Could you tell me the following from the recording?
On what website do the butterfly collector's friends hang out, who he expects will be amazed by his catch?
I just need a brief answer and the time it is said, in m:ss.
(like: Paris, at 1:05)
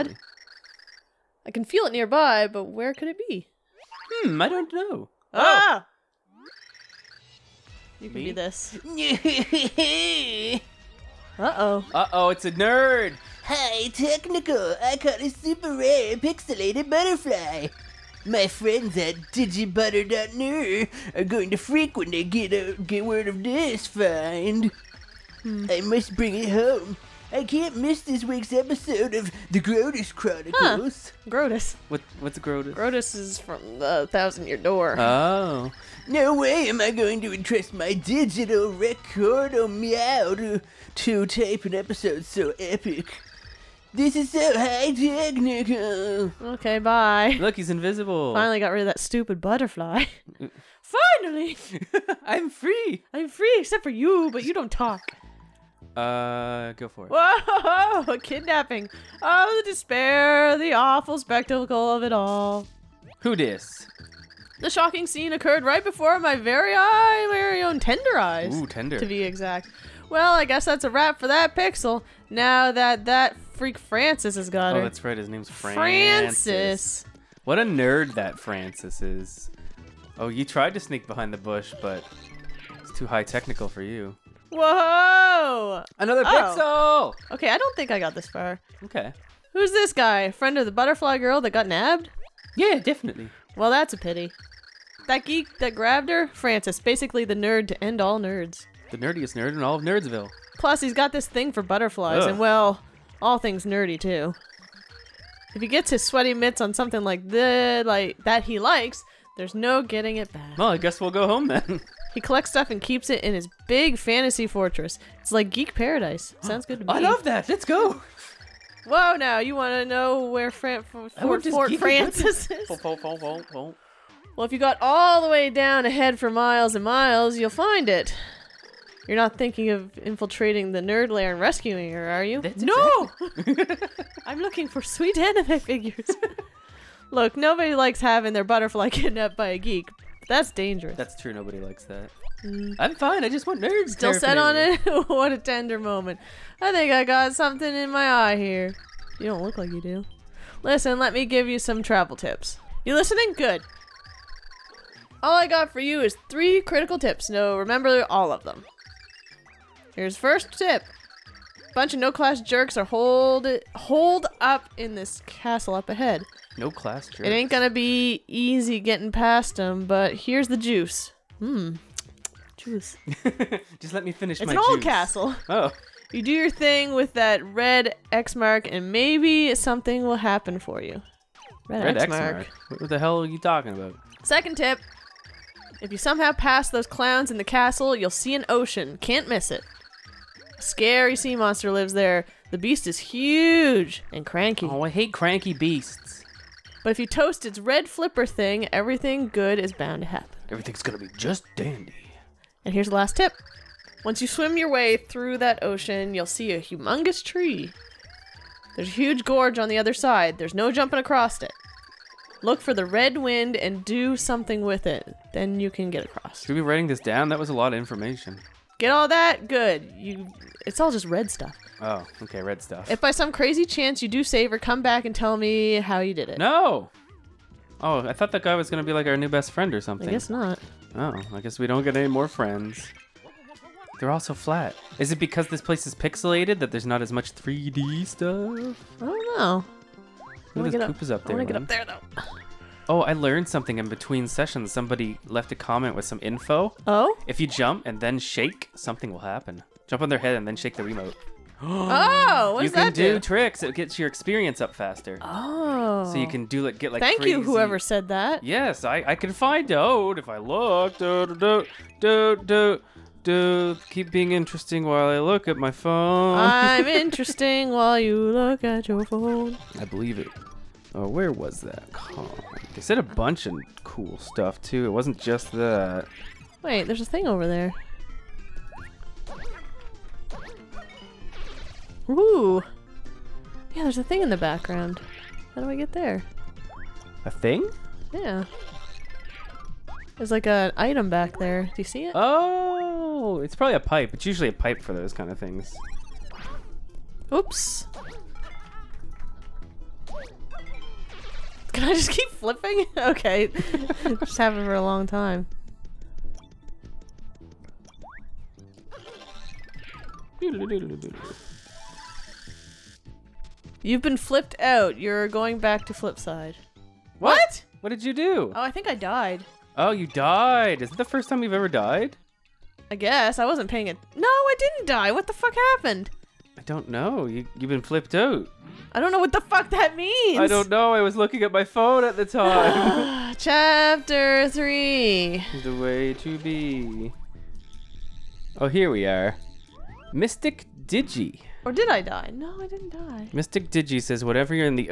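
digibutter.nu, at 0:19.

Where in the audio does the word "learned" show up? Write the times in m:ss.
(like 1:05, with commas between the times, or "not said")
4:03.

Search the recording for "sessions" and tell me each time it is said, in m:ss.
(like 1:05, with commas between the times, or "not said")
4:04.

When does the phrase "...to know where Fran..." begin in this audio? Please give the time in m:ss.
1:59.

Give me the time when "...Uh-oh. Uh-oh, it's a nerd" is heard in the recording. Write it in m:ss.
0:11.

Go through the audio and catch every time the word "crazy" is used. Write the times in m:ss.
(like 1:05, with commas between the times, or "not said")
3:43, 4:17.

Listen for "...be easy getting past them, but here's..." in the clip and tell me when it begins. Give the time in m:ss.
2:47.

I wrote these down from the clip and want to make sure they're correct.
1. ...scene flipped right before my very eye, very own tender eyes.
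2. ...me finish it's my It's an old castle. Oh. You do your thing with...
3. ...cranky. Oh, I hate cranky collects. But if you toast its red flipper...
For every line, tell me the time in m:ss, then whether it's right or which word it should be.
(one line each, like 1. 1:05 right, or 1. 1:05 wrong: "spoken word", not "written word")
1. 1:05 wrong: "occurred", not "flipped"
2. 2:54 right
3. 3:14 wrong: "beasts", not "collects".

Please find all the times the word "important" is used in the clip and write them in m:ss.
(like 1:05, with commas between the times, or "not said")
not said.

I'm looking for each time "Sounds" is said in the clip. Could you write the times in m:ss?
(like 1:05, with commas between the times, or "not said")
1:56.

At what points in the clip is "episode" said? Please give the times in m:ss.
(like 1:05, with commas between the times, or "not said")
0:28, 0:41.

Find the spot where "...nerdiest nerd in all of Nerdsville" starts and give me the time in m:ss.
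1:38.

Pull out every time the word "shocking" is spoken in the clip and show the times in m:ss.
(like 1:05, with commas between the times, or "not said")
1:04.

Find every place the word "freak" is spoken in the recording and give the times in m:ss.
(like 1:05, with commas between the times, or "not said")
0:21, 1:13.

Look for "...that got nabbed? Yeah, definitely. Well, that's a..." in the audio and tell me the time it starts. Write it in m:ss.
1:31.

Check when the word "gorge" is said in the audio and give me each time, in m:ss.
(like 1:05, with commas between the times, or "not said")
3:29.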